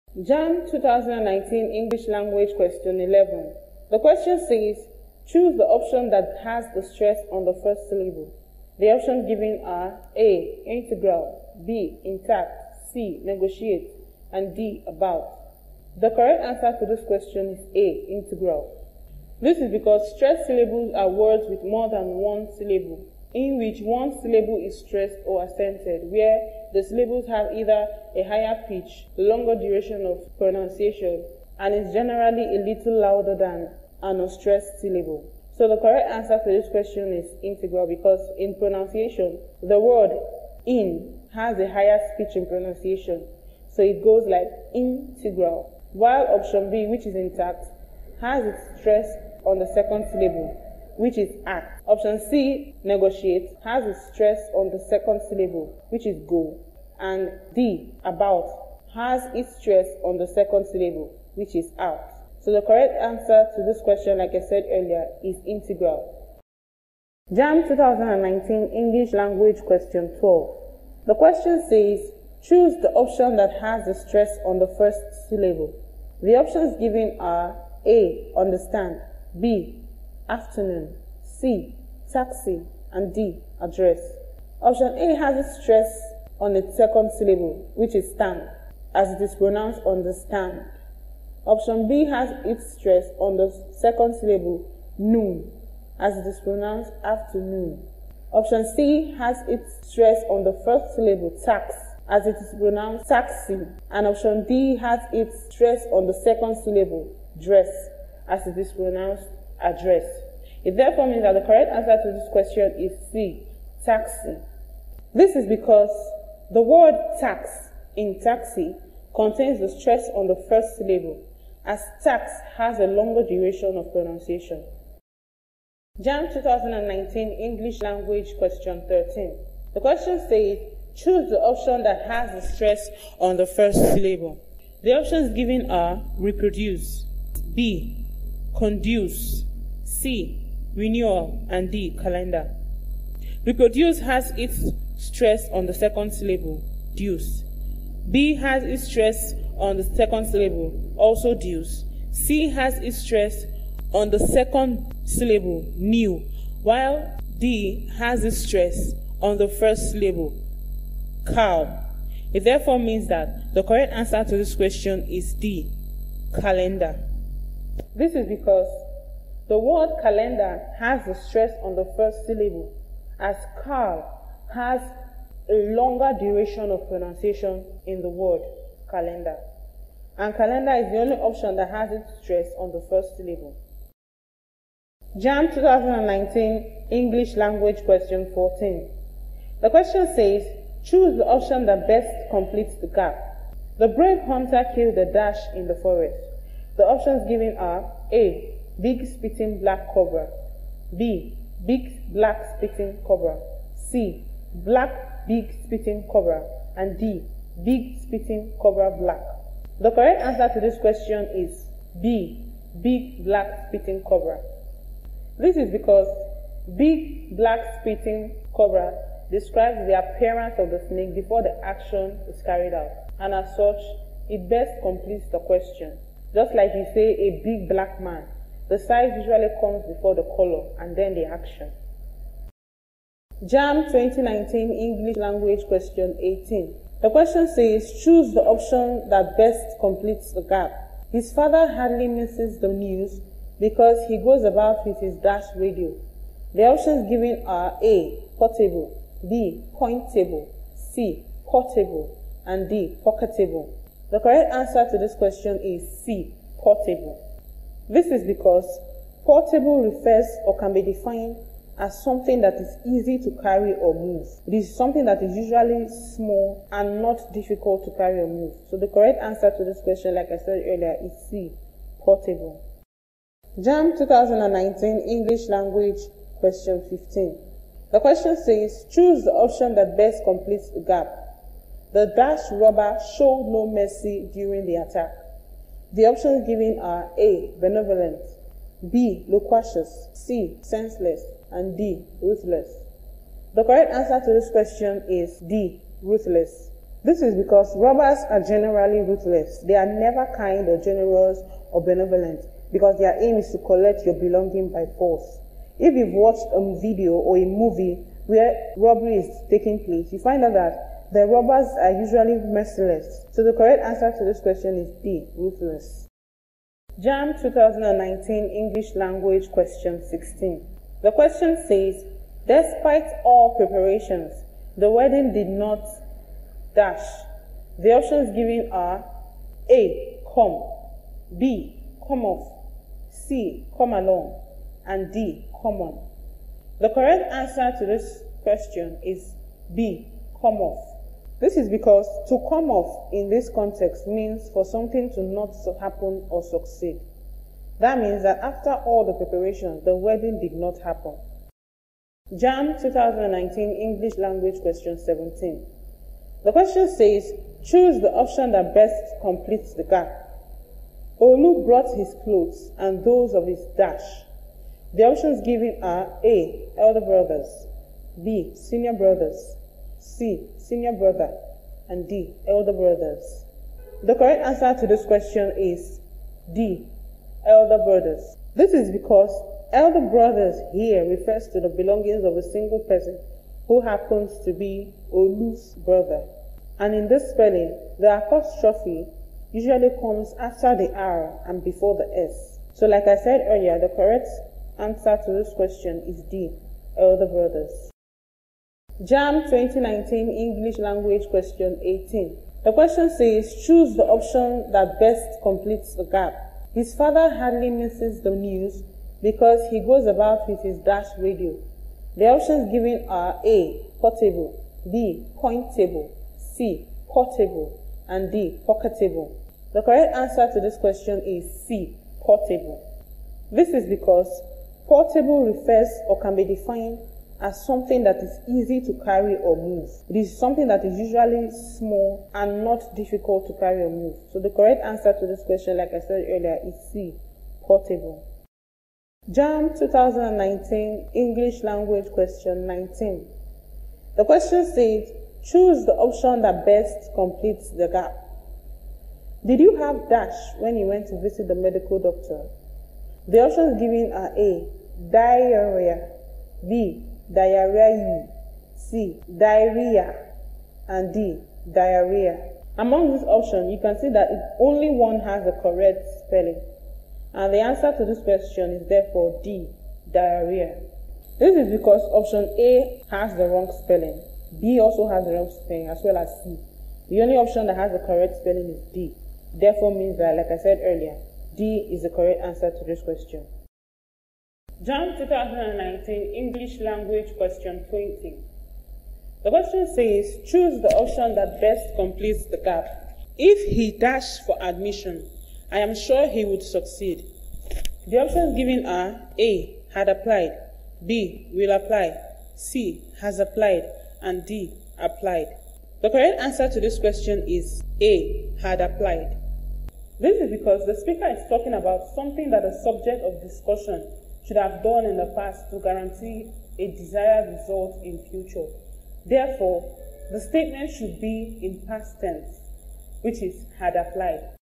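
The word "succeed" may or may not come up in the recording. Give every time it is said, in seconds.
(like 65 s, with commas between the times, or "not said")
346 s, 496 s.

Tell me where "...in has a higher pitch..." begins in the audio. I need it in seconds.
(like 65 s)
40 s.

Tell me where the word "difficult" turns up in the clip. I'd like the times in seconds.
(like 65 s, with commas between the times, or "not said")
267 s, 432 s.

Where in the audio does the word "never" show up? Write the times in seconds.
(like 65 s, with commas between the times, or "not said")
299 s.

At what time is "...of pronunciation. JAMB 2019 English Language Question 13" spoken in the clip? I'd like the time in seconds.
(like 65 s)
123 s.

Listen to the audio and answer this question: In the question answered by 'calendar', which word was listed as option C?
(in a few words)
Renewal.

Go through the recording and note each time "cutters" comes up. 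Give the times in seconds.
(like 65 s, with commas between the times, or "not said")
not said.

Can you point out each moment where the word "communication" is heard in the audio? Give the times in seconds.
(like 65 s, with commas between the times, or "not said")
not said.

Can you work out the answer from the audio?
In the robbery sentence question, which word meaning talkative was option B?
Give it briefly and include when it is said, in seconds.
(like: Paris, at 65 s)
Loquacious, at 288 s.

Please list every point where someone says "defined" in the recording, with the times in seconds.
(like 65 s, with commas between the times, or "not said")
260 s, 426 s.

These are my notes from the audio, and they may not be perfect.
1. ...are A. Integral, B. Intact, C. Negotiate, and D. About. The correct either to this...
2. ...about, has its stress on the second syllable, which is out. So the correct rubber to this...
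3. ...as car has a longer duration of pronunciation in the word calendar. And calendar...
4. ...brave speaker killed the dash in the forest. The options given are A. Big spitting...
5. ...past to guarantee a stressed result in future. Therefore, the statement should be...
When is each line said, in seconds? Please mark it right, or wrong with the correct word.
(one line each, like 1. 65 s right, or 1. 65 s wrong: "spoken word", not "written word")
1. 9 s wrong: "answer", not "either"
2. 58 s wrong: "answer", not "rubber"
3. 173 s right
4. 193 s wrong: "hunter", not "speaker"
5. 515 s wrong: "desired", not "stressed".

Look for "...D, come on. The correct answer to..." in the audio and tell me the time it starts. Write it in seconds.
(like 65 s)
335 s.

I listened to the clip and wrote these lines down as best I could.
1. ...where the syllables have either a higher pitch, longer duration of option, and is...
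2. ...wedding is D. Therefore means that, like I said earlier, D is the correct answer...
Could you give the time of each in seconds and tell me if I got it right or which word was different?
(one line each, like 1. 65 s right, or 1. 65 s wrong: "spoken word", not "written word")
1. 26 s wrong: "pronunciation", not "option"
2. 478 s wrong: "spelling", not "wedding".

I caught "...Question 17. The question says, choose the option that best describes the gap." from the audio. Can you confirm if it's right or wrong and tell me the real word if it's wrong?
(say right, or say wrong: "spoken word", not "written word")
wrong: "completes", not "describes".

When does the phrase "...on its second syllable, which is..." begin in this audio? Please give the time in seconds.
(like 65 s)
86 s.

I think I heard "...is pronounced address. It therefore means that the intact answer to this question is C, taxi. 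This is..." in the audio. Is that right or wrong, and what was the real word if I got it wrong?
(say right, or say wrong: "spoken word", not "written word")
wrong: "correct", not "intact".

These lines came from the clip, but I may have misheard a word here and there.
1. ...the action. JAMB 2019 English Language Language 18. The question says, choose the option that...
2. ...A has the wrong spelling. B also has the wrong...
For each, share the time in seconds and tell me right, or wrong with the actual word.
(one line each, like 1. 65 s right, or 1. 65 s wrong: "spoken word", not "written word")
1. 231 s wrong: "Question", not "Language"
2. 472 s right.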